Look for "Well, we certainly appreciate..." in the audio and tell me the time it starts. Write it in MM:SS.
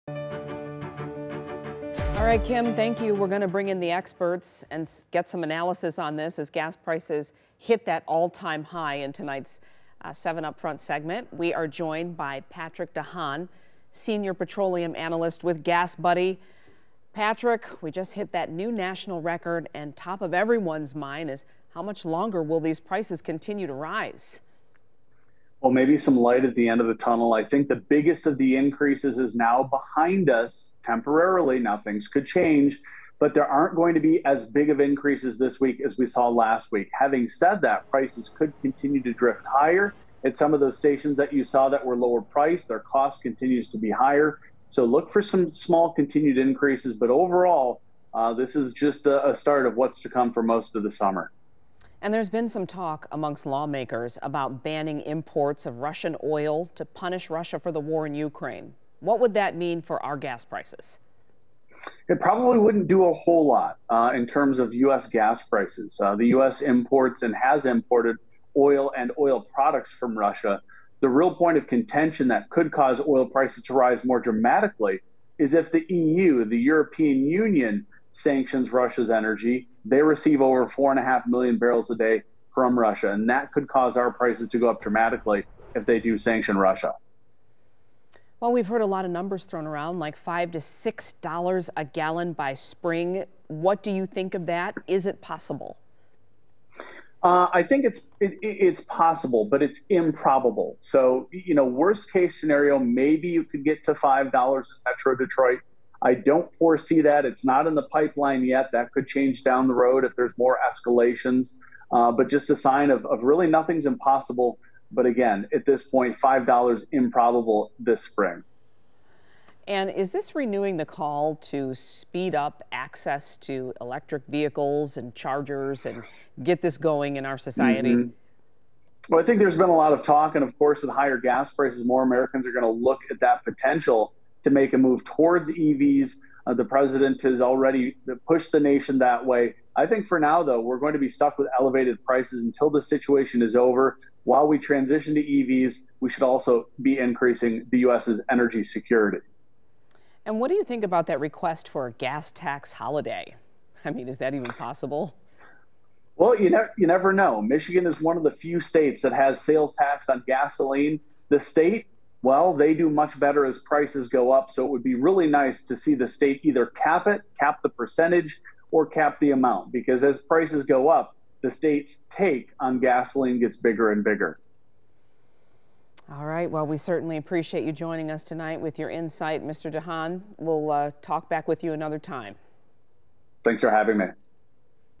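02:56.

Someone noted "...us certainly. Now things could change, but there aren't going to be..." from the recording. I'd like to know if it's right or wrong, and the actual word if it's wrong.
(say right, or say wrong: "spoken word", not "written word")
wrong: "temporarily", not "certainly".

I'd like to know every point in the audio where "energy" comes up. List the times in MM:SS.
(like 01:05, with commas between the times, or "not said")
01:19, 02:28.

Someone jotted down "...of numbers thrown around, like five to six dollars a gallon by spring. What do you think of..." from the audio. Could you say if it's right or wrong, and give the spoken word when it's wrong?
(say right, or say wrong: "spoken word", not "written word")
right.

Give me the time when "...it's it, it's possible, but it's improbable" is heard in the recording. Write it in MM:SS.
01:37.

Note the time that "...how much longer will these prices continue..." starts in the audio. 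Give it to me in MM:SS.
00:21.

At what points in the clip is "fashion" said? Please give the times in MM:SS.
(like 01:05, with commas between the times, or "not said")
not said.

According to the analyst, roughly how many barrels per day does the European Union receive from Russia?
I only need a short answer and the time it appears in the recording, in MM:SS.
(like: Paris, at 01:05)
4.5 million, at 01:20.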